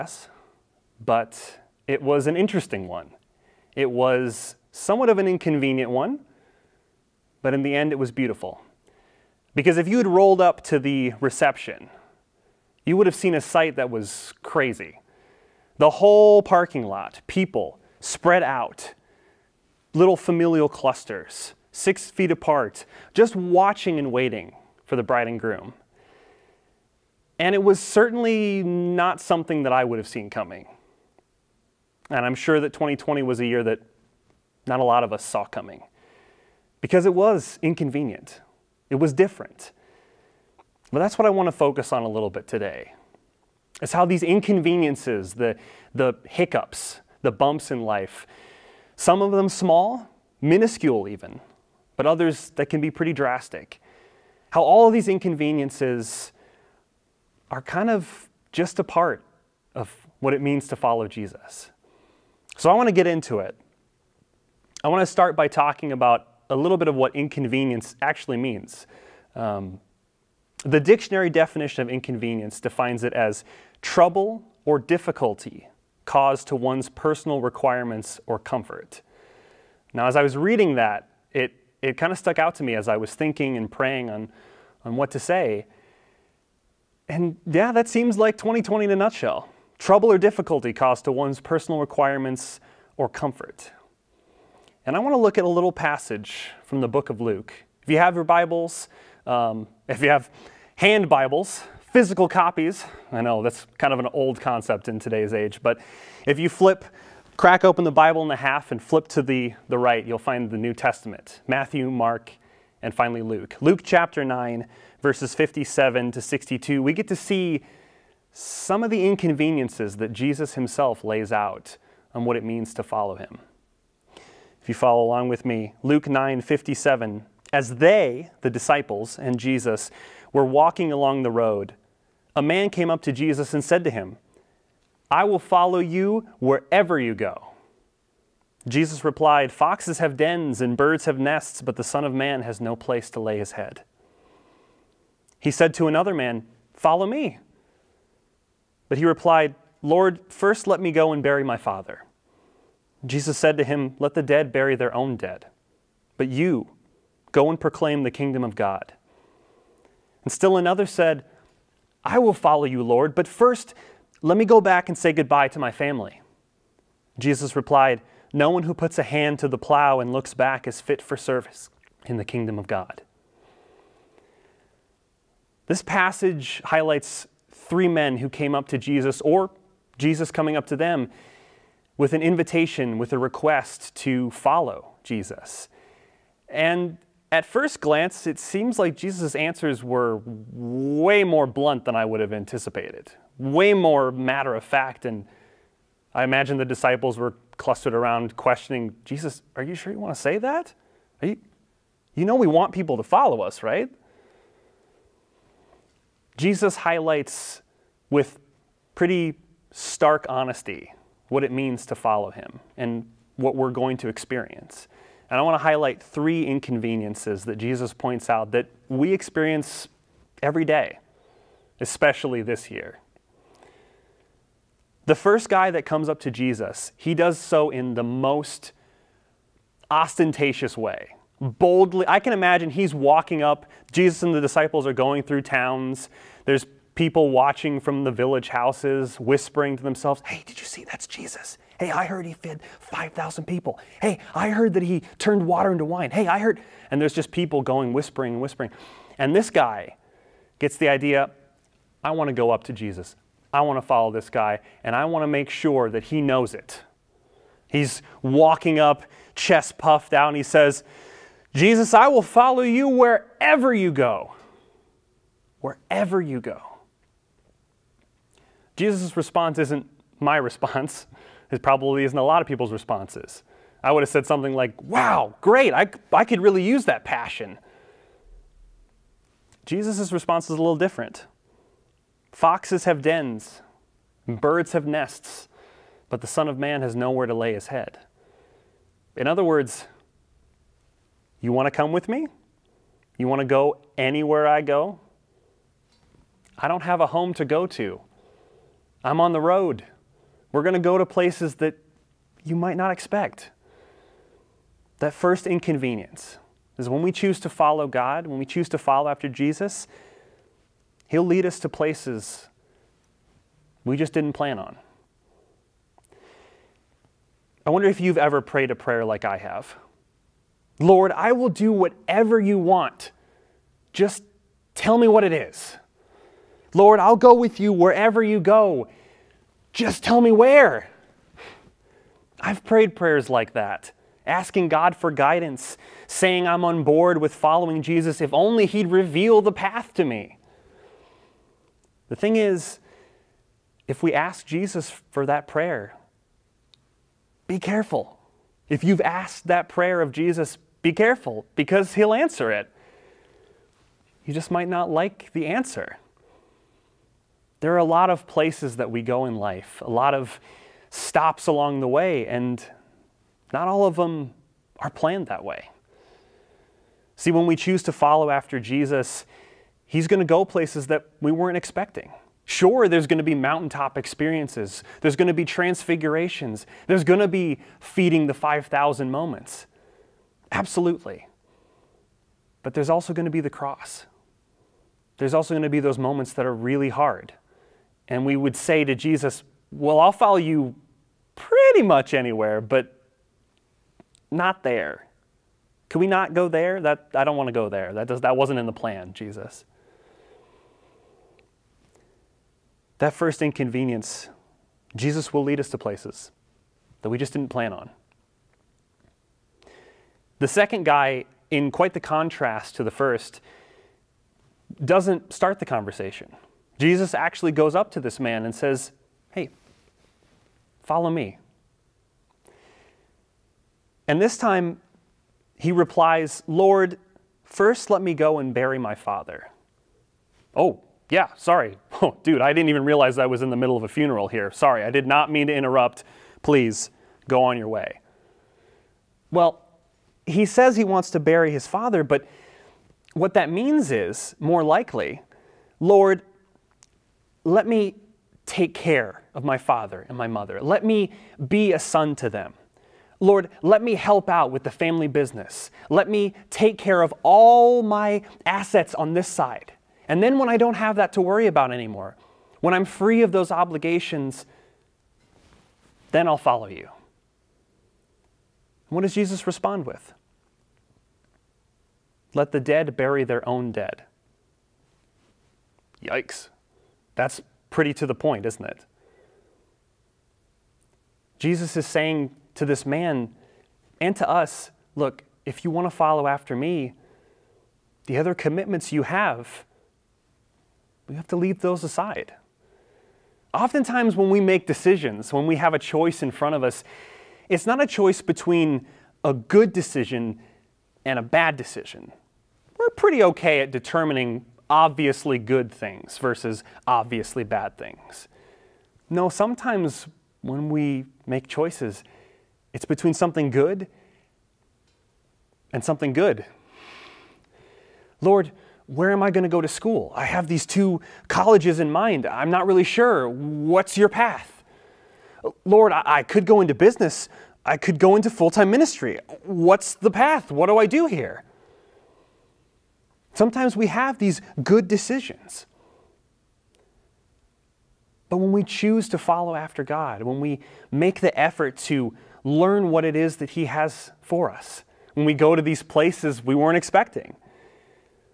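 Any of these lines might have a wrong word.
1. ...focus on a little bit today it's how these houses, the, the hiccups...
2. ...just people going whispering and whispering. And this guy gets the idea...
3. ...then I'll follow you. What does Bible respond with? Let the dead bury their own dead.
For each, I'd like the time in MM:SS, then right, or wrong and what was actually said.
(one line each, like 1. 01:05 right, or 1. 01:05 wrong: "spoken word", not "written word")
1. 00:41 wrong: "inconveniences", not "houses"
2. 04:07 right
3. 07:46 wrong: "Jesus", not "Bible".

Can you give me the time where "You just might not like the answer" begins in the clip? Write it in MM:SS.
05:54.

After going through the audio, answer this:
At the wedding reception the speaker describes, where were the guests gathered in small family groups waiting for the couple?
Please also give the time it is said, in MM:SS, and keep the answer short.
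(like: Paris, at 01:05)
Parking lot, at 00:16.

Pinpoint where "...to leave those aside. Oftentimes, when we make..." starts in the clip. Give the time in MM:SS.
08:11.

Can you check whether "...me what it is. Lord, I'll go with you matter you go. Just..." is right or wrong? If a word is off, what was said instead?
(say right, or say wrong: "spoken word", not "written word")
wrong: "wherever", not "matter".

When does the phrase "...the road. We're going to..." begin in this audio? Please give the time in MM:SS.
04:59.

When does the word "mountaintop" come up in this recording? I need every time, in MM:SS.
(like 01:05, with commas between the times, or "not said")
06:13.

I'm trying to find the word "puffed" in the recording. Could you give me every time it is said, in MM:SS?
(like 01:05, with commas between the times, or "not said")
04:19.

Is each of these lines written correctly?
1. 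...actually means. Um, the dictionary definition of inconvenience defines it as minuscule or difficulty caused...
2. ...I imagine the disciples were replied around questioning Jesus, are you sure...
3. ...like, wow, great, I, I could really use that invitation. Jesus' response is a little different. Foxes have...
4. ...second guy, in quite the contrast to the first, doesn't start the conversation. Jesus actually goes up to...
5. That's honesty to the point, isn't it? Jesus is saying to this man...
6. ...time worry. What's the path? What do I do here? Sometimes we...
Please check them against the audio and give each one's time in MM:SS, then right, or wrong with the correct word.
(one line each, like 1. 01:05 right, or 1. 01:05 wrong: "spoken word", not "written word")
1. 01:08 wrong: "trouble", not "minuscule"
2. 03:16 wrong: "clustered", not "replied"
3. 04:34 wrong: "passion", not "invitation"
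4. 06:50 right
5. 07:57 wrong: "pretty", not "honesty"
6. 08:48 wrong: "ministry", not "worry".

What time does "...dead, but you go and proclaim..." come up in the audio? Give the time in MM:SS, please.
02:35.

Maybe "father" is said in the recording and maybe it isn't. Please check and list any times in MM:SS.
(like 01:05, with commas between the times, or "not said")
02:31, 07:08, 07:21, 07:29.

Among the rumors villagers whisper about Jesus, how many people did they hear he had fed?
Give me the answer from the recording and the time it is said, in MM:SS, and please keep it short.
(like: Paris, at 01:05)
5,000, at 04:02.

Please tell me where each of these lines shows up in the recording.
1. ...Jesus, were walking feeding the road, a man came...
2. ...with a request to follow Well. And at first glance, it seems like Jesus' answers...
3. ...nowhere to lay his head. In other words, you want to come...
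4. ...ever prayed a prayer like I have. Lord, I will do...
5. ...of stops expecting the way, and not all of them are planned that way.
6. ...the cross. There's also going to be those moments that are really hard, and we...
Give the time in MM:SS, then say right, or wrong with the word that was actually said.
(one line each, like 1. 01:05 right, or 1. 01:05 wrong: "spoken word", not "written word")
1. 02:09 wrong: "along", not "feeding"
2. 03:02 wrong: "Jesus", not "Well"
3. 04:46 right
4. 05:18 right
5. 06:00 wrong: "along", not "expecting"
6. 06:23 right.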